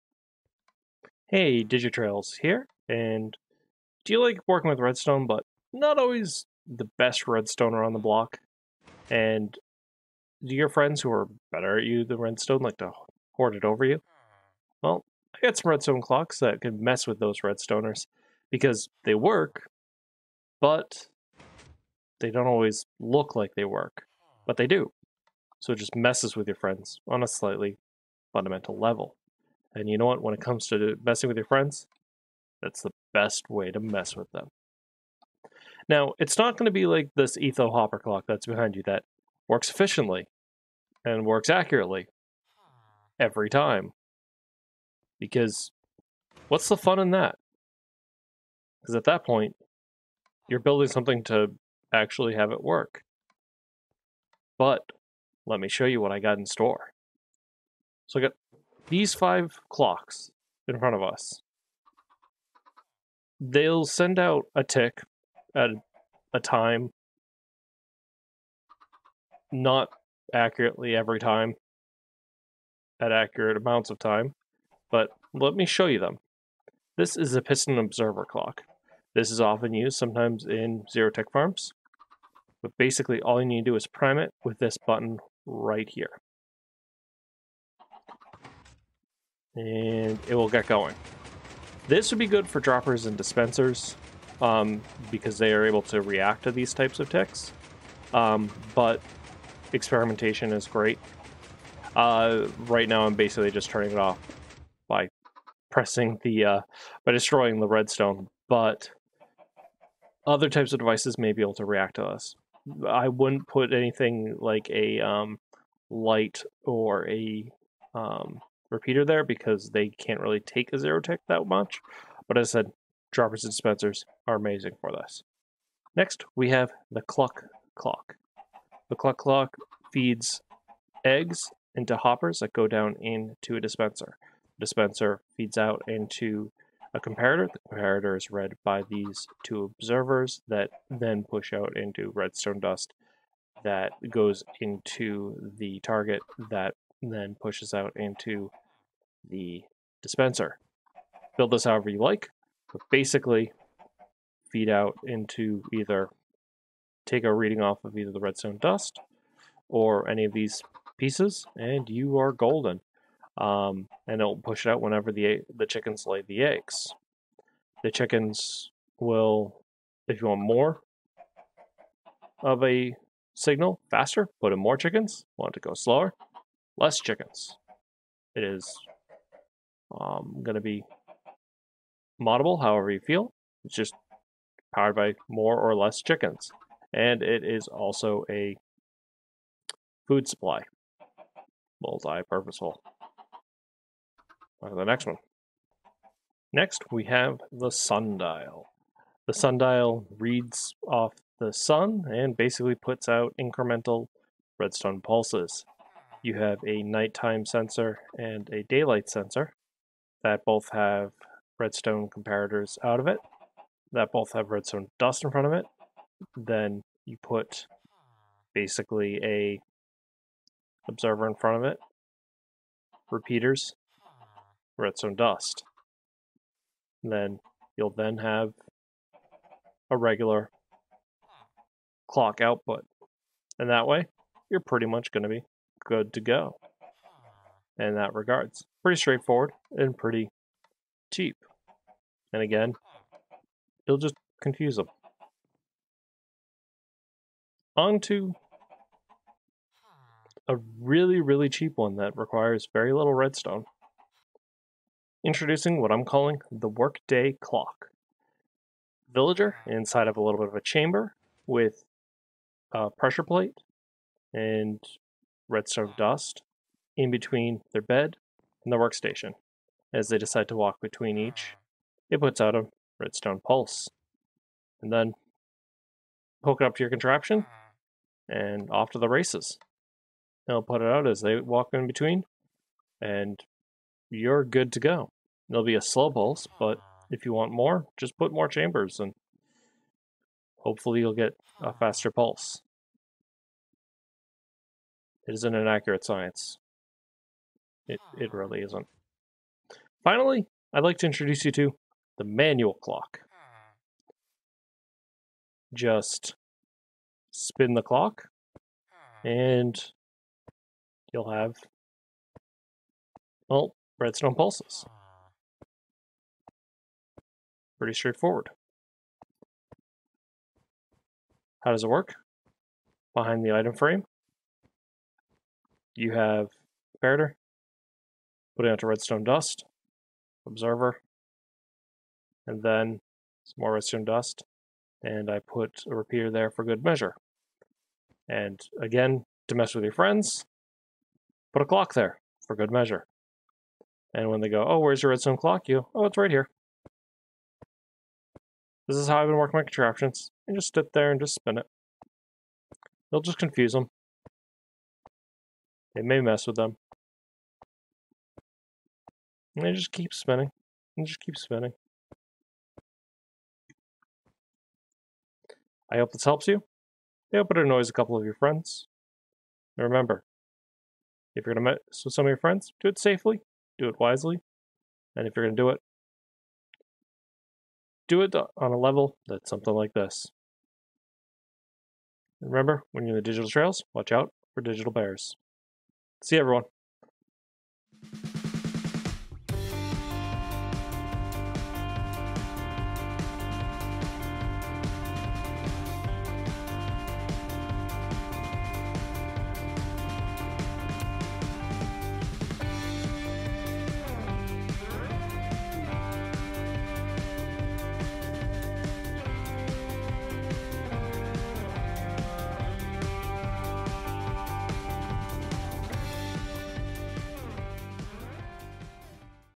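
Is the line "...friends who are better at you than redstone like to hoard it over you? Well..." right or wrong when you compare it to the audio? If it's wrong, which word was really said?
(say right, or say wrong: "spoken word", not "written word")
right.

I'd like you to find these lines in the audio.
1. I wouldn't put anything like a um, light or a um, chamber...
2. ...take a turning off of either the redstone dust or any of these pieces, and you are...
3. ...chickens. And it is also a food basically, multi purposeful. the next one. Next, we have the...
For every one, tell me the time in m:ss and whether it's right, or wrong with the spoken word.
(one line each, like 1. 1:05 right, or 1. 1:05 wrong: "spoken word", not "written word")
1. 1:52 wrong: "repeater", not "chamber"
2. 2:37 wrong: "reading", not "turning"
3. 3:06 wrong: "supply", not "basically".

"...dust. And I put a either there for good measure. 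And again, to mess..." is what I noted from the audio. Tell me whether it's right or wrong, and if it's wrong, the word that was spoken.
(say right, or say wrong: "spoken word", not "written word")
wrong: "repeater", not "either".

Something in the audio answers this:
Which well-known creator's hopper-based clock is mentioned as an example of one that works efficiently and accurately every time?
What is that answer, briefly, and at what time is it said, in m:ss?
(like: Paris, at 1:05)
Etho, at 0:37.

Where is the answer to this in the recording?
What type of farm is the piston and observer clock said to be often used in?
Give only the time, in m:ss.
1:20.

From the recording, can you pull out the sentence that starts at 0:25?
So it just messes with your friends on a slightly fundamental level.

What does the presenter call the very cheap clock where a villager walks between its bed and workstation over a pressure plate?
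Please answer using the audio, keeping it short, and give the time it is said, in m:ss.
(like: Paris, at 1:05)
workday clock, at 4:16.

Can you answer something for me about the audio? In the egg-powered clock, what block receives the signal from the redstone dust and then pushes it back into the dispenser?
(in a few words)
target.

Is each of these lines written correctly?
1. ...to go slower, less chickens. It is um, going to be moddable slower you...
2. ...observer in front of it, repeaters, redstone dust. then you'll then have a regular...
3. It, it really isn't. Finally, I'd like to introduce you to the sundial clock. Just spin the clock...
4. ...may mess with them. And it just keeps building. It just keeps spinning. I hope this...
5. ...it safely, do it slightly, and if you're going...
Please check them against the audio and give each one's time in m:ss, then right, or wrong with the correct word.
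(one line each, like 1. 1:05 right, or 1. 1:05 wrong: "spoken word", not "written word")
1. 2:55 wrong: "however", not "slower"
2. 3:40 right
3. 4:57 wrong: "manual", not "sundial"
4. 5:56 wrong: "spinning", not "building"
5. 6:12 wrong: "wisely", not "slightly".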